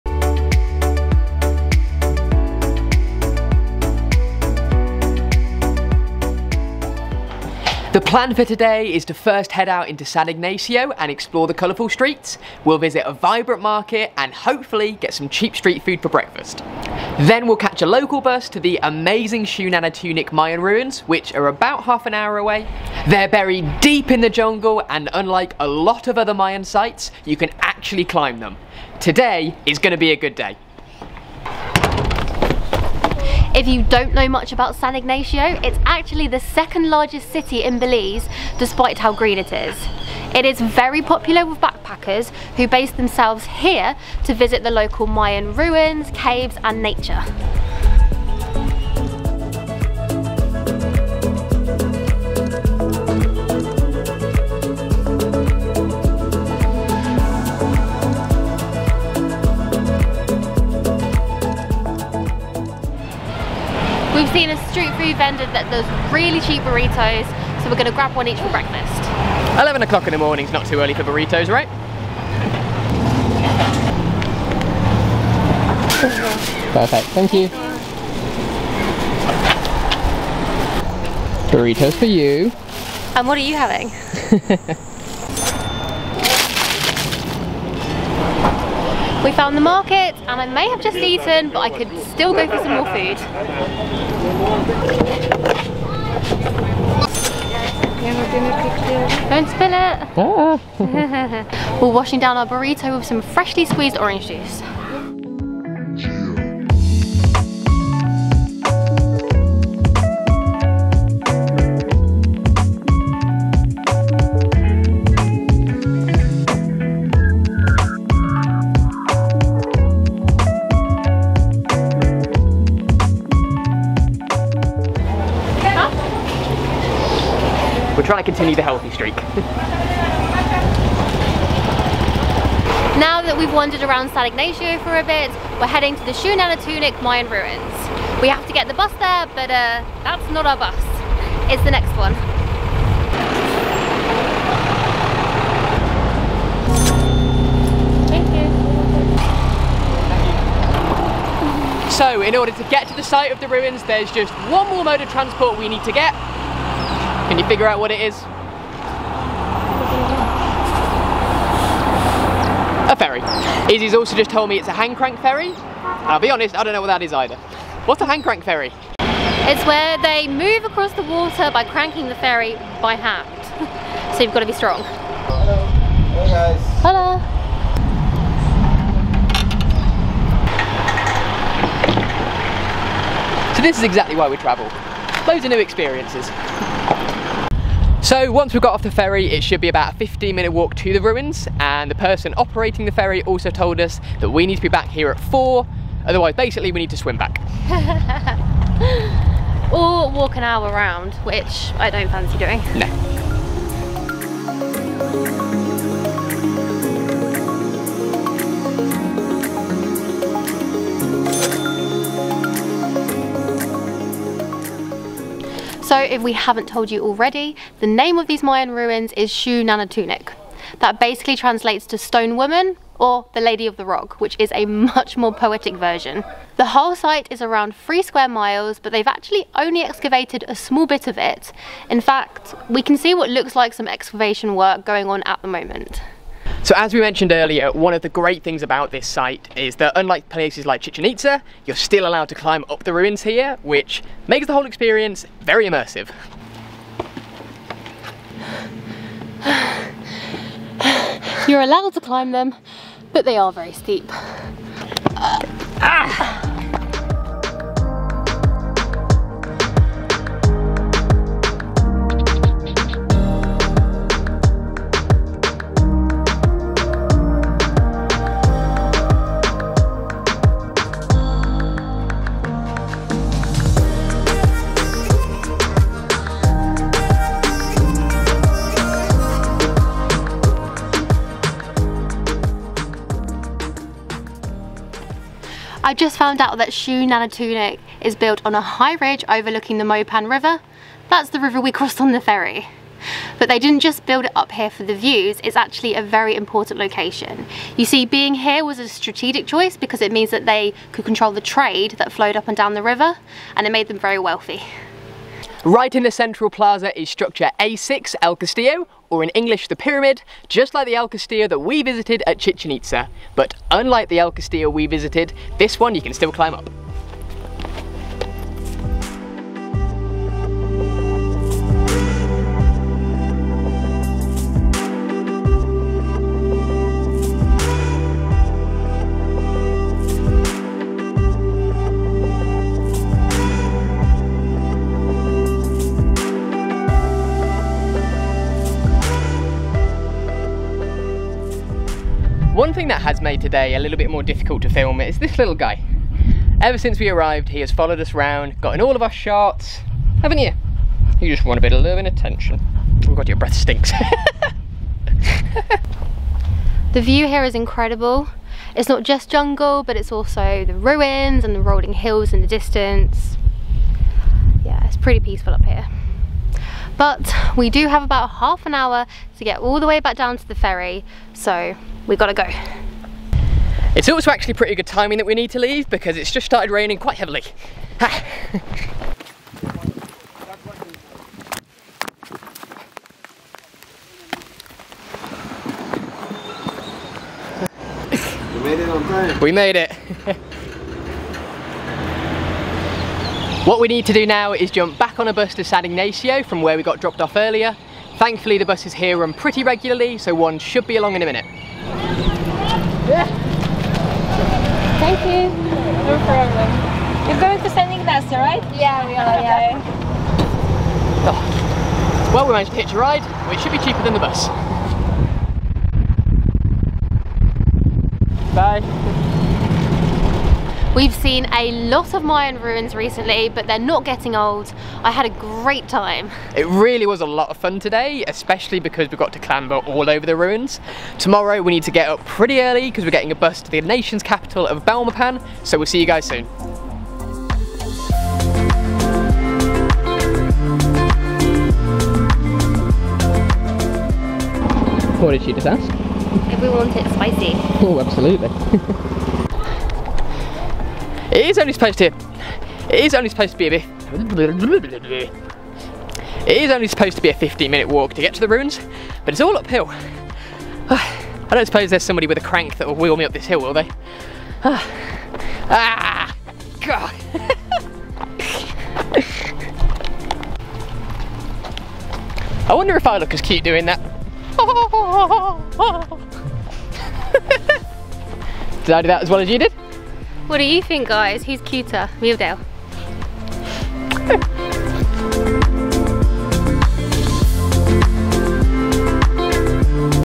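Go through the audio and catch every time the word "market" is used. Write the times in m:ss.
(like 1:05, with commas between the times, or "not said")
0:13, 1:29.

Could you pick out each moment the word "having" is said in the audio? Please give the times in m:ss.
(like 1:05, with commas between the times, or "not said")
1:23.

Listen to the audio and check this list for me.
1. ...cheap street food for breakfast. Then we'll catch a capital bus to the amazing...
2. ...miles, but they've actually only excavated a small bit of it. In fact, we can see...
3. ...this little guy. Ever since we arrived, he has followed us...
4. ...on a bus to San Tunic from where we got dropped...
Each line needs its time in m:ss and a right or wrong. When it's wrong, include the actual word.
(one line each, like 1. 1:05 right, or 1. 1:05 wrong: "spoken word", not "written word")
1. 0:15 wrong: "local", not "capital"
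2. 3:48 right
3. 5:45 right
4. 6:35 wrong: "Ignacio", not "Tunic".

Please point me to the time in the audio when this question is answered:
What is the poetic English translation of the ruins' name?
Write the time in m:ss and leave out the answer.
3:43.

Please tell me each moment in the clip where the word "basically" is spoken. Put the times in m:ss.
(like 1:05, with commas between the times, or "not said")
3:16, 3:41.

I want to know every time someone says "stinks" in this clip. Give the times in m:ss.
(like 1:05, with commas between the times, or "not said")
5:53.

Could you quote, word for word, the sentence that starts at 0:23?
They're buried deep in the jungle and unlike a lot of other Mayan sites, you can actually climb them.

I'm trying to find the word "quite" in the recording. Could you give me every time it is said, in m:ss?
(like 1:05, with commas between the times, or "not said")
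6:16.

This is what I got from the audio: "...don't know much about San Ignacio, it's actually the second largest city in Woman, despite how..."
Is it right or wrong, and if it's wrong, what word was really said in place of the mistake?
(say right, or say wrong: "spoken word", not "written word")
wrong: "Belize", not "Woman".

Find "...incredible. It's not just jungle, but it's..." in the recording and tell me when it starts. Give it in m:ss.
5:57.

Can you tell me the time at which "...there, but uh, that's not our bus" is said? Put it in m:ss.
2:18.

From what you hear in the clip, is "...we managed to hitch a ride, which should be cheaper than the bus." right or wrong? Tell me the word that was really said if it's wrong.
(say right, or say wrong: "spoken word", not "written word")
right.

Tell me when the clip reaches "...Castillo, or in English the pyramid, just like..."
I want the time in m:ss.
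5:08.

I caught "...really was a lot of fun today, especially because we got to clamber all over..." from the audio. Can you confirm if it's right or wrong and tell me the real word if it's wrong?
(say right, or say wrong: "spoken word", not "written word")
right.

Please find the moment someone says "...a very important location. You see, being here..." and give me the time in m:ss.
4:55.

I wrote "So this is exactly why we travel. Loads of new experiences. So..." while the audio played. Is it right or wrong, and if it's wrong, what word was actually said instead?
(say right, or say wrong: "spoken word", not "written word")
right.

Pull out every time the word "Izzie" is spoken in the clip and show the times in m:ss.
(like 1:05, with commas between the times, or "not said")
2:43.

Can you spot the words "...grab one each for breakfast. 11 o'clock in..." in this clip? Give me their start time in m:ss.
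1:07.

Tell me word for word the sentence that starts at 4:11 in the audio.
You're allowed to climb them, but they are very steep.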